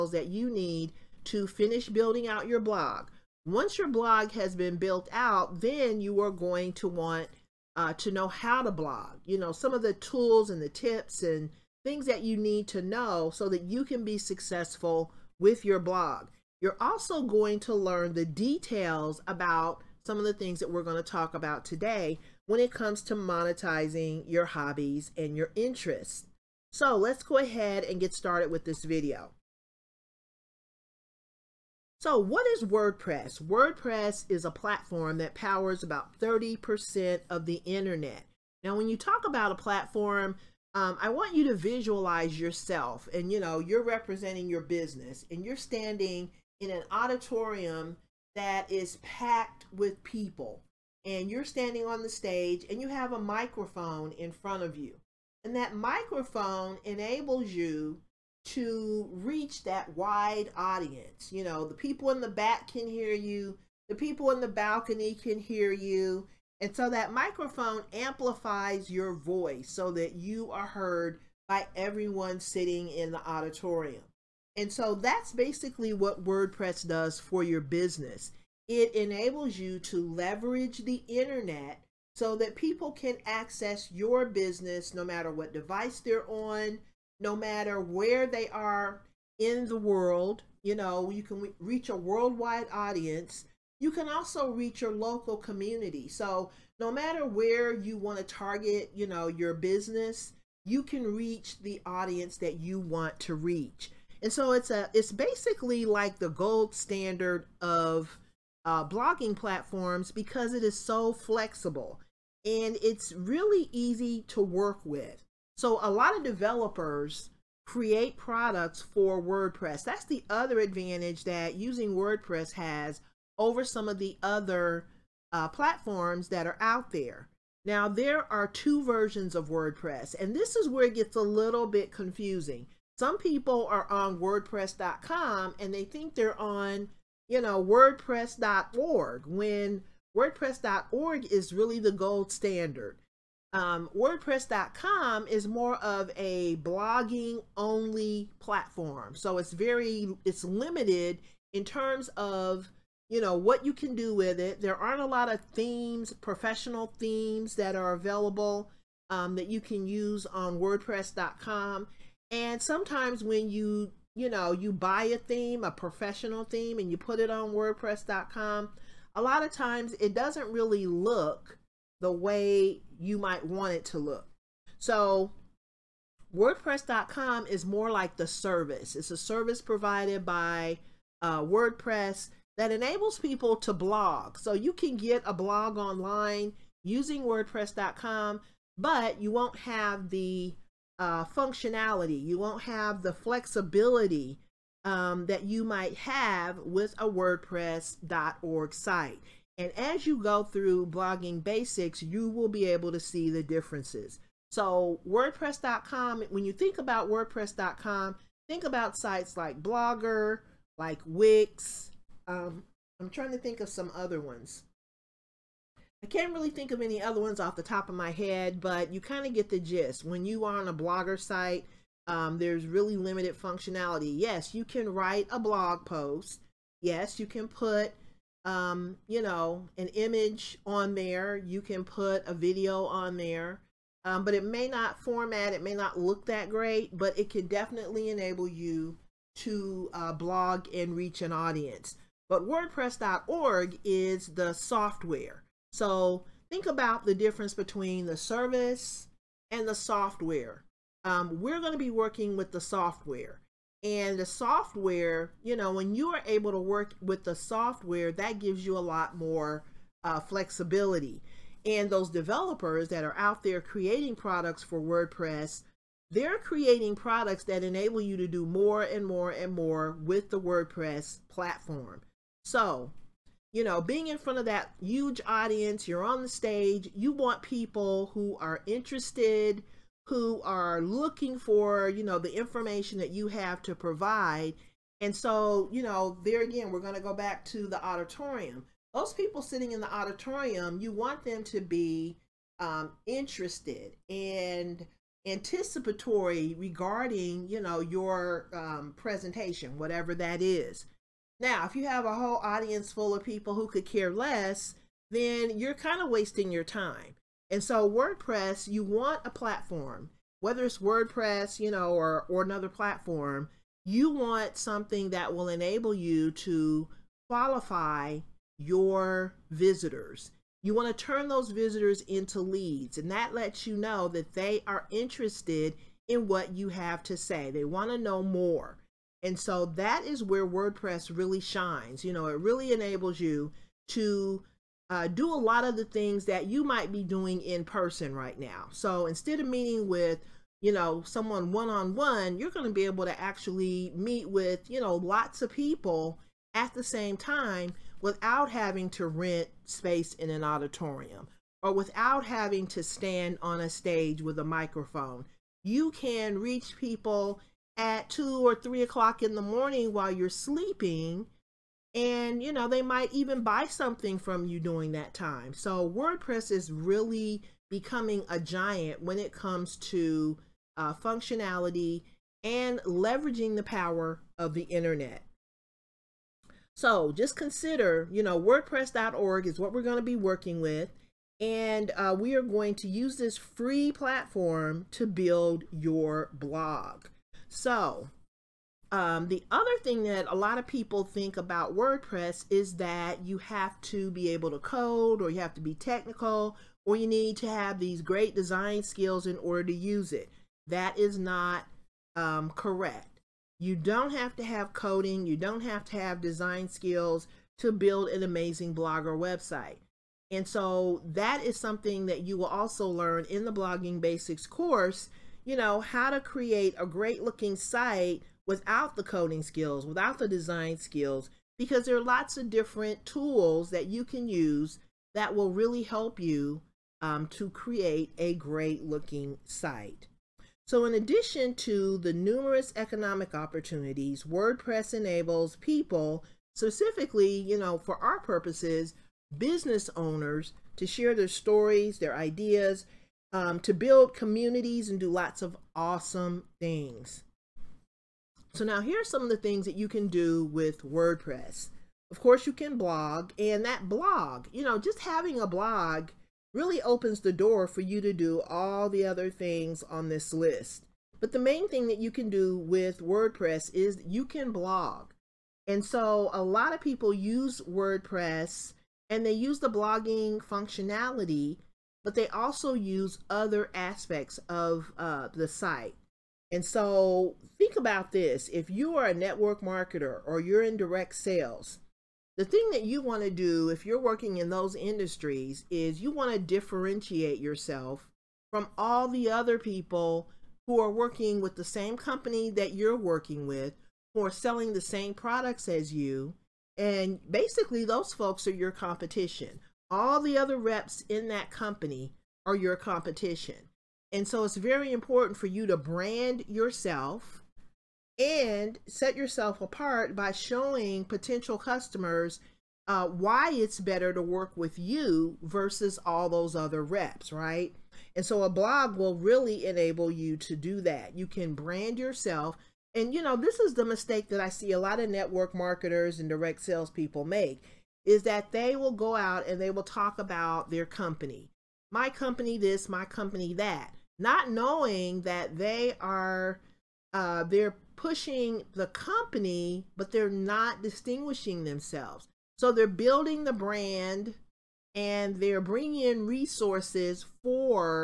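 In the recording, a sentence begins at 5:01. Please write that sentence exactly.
Now, if you have a whole audience full of people who could care less, then you're kind of wasting your time.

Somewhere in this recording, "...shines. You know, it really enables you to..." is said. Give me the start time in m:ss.
5:31.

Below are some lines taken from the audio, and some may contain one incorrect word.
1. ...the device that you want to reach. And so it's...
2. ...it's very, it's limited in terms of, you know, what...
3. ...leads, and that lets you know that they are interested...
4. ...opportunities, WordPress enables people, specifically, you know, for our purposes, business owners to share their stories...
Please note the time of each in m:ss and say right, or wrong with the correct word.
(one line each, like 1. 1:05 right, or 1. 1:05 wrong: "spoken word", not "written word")
1. 1:41 wrong: "audience", not "device"
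2. 2:29 right
3. 5:22 right
4. 7:13 right.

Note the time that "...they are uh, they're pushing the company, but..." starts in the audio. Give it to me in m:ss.
8:55.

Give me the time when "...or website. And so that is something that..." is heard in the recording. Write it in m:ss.
6:49.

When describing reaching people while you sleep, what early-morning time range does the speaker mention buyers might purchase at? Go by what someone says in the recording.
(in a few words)
2 or 3 o'clock.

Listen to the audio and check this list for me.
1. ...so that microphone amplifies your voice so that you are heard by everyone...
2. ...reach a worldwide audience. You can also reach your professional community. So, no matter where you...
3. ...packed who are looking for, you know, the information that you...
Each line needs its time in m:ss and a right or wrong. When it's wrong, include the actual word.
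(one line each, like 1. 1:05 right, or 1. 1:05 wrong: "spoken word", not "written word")
1. 1:06 right
2. 1:31 wrong: "local", not "professional"
3. 4:38 wrong: "interested", not "packed".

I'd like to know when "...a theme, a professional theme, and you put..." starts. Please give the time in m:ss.
2:45.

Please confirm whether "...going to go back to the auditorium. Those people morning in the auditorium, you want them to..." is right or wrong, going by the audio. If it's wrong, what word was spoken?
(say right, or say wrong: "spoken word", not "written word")
wrong: "sitting", not "morning".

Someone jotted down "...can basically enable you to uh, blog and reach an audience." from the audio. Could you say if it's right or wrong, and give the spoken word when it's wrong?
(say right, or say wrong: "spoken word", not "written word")
wrong: "definitely", not "basically".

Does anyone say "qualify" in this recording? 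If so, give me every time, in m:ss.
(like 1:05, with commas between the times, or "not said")
5:17.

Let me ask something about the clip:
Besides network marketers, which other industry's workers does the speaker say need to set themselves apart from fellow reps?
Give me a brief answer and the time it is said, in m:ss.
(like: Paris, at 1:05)
Direct sales, at 8:00.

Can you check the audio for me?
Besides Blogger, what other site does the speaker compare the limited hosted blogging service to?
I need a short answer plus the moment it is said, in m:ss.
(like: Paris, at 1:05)
Wix, at 3:31.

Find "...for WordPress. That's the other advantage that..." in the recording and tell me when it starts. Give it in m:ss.
1:58.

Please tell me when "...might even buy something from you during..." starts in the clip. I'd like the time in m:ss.
6:02.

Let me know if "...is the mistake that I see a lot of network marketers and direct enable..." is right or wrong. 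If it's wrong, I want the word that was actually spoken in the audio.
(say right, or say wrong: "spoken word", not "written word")
wrong: "salespeople", not "enable".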